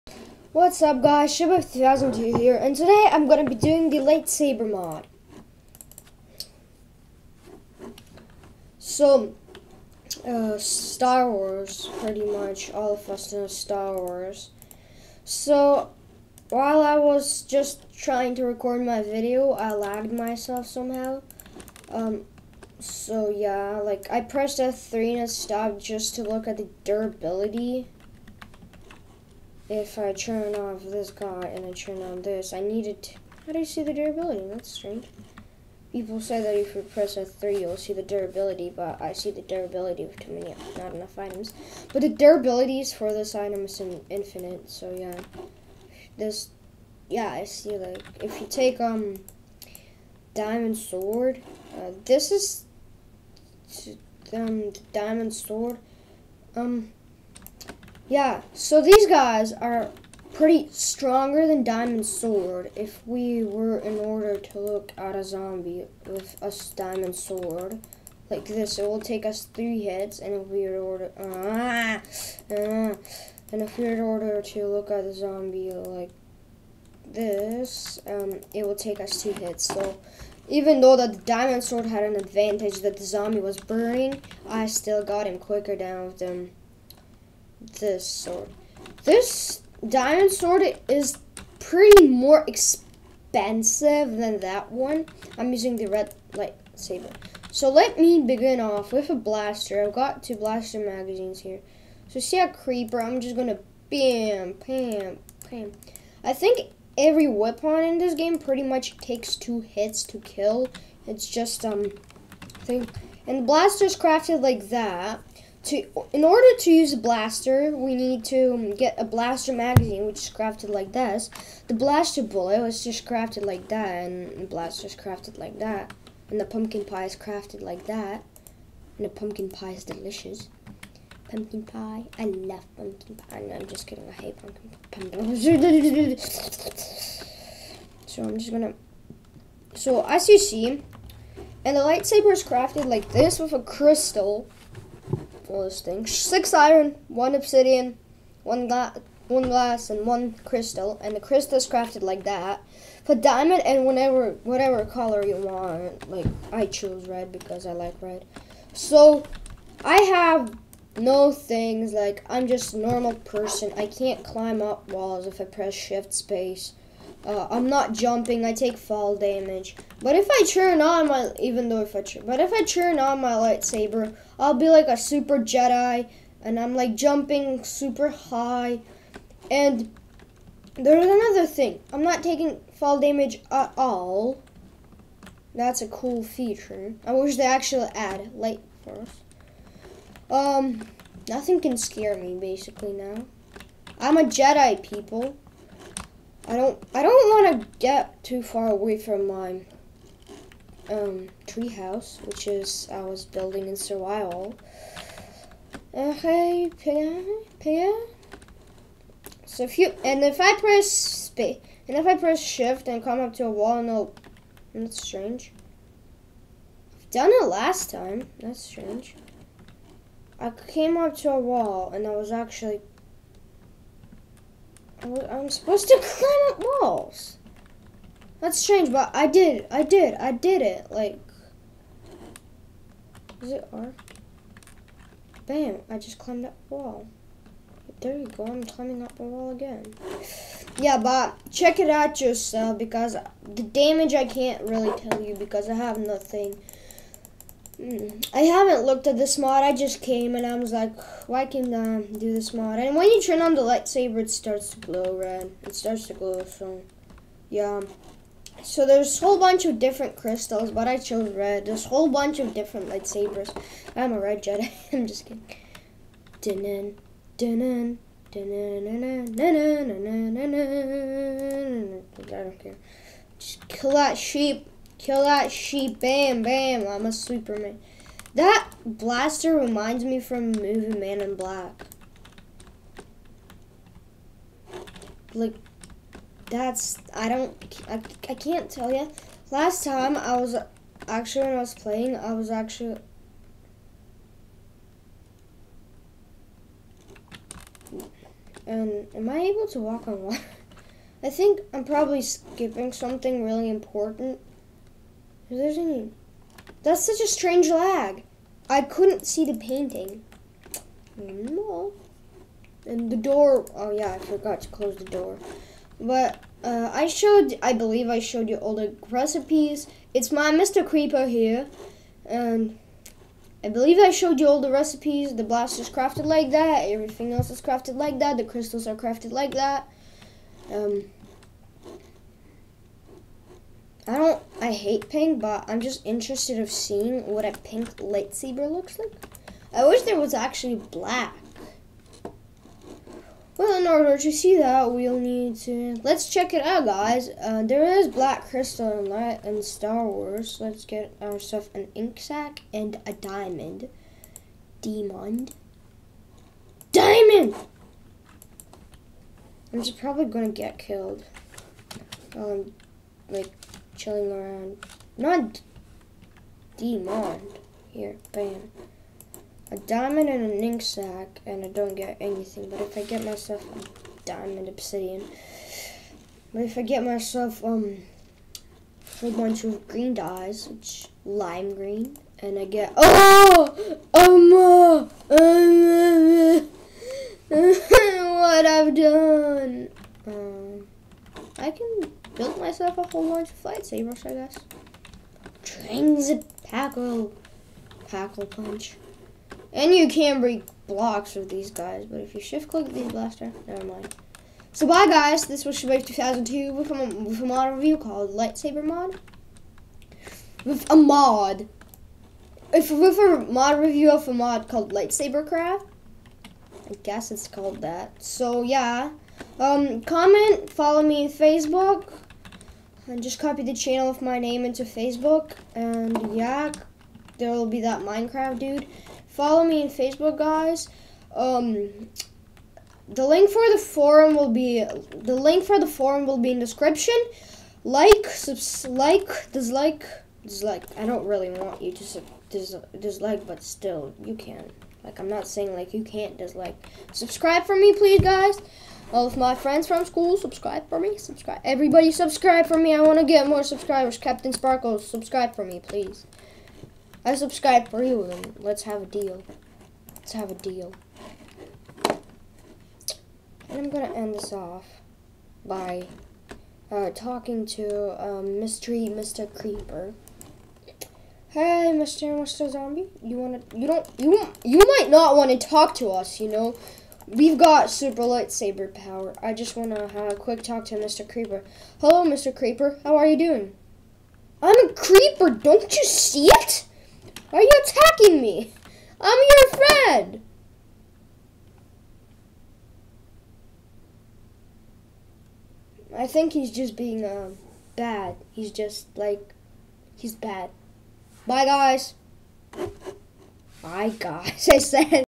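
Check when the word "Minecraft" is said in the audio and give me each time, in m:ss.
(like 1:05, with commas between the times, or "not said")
7:08.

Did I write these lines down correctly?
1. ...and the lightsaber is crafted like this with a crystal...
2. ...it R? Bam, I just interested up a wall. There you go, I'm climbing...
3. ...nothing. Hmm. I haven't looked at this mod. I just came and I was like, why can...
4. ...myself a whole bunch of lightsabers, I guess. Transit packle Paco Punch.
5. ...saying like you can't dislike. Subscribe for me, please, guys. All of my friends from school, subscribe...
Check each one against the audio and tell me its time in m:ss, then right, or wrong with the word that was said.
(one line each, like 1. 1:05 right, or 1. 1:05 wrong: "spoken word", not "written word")
1. 2:21 right
2. 3:53 wrong: "climbed", not "interested"
3. 4:05 right
4. 6:32 right
5. 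7:25 right.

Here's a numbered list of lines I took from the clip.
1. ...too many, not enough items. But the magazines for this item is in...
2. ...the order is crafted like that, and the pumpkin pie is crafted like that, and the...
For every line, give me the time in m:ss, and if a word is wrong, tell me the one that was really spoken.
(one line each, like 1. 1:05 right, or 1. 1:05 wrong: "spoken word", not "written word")
1. 0:40 wrong: "durabilities", not "magazines"
2. 2:04 wrong: "blaster", not "order".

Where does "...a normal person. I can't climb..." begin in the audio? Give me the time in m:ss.
2:42.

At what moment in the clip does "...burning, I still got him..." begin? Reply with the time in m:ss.
1:23.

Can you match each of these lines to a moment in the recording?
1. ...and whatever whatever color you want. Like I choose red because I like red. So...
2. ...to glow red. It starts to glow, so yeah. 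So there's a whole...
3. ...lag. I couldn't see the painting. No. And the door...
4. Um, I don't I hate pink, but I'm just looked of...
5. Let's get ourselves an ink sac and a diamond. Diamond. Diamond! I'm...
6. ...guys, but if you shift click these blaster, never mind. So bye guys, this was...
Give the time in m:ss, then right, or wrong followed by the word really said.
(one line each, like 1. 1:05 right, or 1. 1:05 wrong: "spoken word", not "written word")
1. 2:33 right
2. 4:14 right
3. 5:07 right
4. 5:30 wrong: "interested", not "looked"
5. 5:50 right
6. 6:41 right.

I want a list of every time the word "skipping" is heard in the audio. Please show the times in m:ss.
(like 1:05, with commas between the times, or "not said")
5:02.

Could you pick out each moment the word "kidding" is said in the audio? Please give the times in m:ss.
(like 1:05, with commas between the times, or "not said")
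2:13, 4:25.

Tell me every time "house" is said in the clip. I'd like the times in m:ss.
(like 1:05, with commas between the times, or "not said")
3:21.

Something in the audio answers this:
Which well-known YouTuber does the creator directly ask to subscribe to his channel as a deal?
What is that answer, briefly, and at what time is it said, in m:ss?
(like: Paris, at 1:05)
CaptainSparklez, at 7:34.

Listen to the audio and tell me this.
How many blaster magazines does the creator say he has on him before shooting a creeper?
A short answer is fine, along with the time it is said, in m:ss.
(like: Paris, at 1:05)
2, at 1:40.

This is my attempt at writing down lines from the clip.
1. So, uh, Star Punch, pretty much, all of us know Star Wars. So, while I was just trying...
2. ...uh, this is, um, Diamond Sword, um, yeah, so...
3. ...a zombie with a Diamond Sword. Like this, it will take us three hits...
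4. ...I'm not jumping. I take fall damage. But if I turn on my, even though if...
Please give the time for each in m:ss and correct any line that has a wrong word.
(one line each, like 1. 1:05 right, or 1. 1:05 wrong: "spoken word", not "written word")
1. 0:08 wrong: "Wars", not "Punch"
2. 0:51 right
3. 1:05 right
4. 2:47 right.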